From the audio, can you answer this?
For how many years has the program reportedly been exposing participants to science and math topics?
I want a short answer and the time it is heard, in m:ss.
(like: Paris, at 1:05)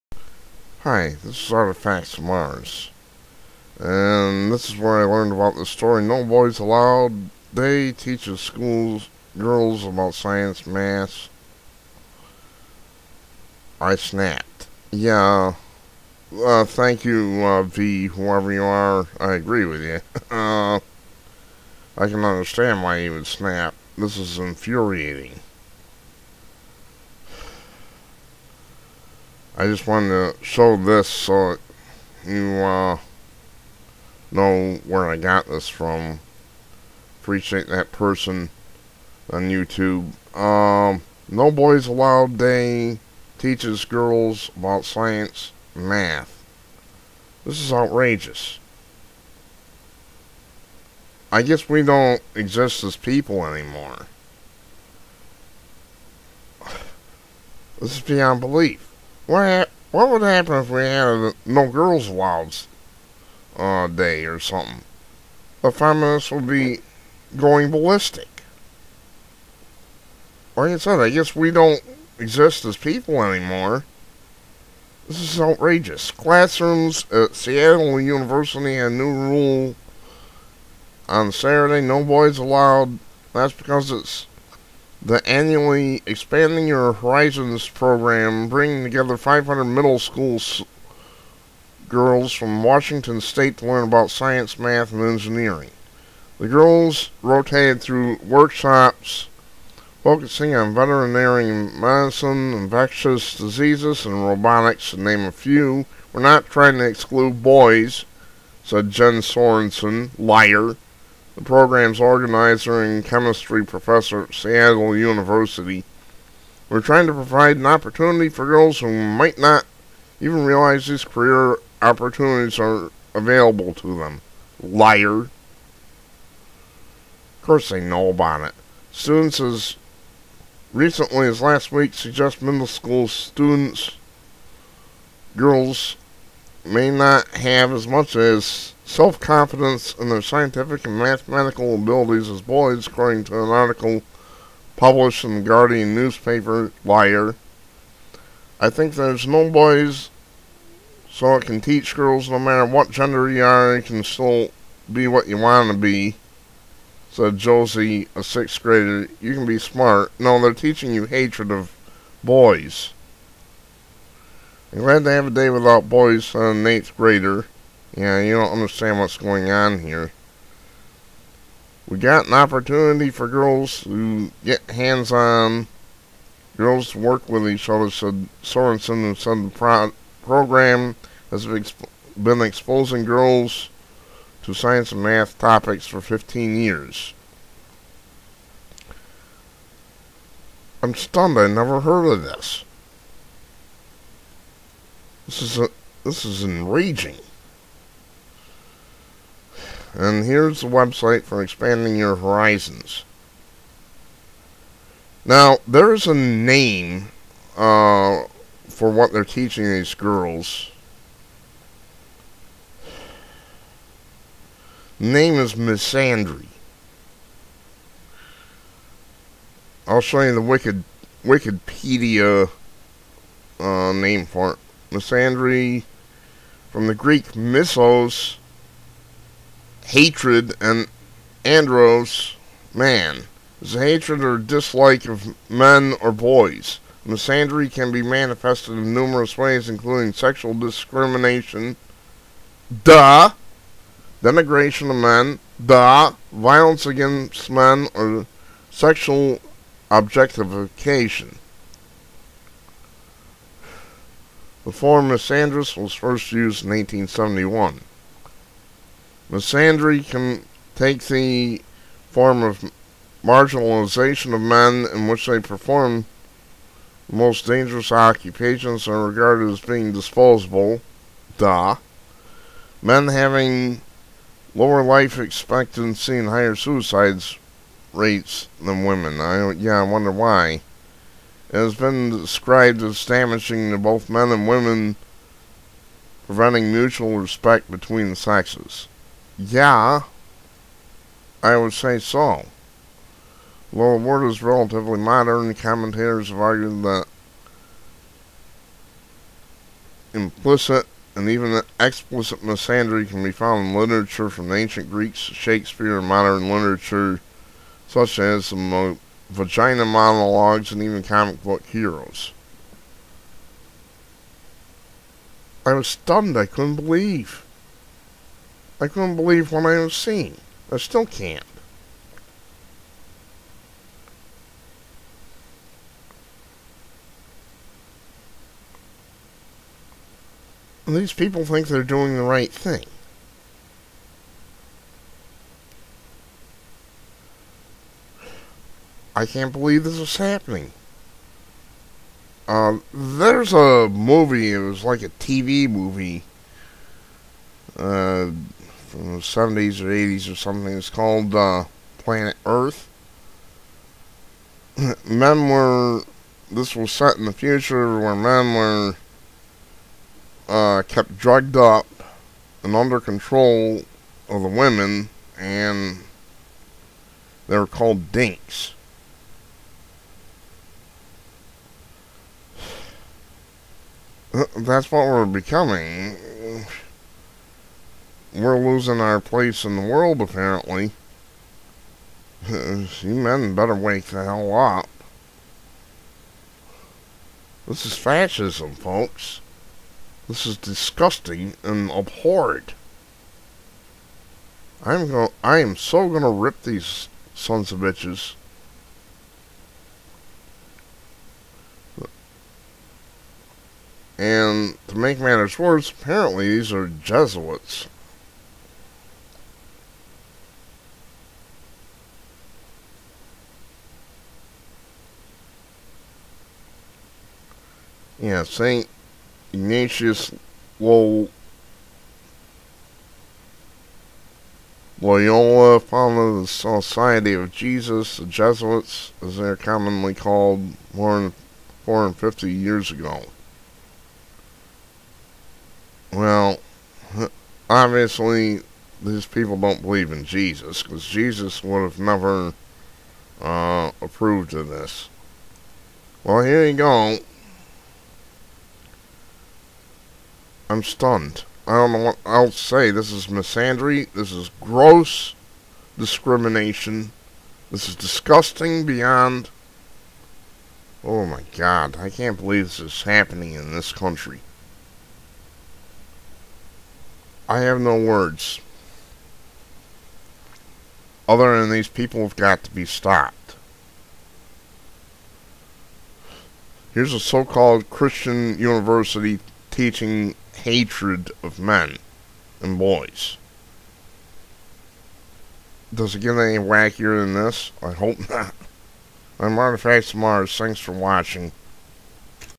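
15, at 3:05.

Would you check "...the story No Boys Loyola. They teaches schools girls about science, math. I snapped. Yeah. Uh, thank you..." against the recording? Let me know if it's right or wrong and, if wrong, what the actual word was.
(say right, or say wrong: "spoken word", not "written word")
wrong: "Allowed", not "Loyola".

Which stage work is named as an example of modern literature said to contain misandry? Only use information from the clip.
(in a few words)
The Vagina Monologues.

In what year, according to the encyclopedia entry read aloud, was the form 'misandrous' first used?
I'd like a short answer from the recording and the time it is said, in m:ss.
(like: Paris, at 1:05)
1871, at 4:16.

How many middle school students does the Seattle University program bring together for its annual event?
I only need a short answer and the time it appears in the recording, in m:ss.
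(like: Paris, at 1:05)
500, at 1:29.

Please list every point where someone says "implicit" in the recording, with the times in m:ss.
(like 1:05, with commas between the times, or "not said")
5:00.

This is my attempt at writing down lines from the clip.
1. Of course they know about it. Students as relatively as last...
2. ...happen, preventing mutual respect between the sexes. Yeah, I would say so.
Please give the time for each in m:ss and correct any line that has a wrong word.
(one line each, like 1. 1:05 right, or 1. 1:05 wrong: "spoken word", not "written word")
1. 2:05 wrong: "recently", not "relatively"
2. 4:44 wrong: "women", not "happen".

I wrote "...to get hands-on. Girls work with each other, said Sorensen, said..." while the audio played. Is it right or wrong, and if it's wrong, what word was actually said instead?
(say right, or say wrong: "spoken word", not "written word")
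right.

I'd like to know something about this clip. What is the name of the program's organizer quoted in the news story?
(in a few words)
Jen Sorensen.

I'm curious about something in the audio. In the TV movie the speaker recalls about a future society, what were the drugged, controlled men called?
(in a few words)
dinks.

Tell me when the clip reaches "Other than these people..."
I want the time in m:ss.
7:51.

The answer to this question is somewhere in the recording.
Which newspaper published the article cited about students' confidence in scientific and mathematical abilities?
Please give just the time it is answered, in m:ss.
2:25.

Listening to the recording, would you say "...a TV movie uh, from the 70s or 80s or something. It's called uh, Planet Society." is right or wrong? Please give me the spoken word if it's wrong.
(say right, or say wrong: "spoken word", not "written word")
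wrong: "Earth", not "Society".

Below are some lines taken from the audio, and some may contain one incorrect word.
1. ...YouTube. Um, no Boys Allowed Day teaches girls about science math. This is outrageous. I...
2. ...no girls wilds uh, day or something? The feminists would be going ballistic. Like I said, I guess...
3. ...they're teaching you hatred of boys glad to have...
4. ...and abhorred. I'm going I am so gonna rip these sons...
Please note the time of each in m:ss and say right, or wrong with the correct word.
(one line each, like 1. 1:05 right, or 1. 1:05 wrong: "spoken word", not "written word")
1. 0:39 right
2. 1:01 right
3. 2:40 right
4. 6:31 right.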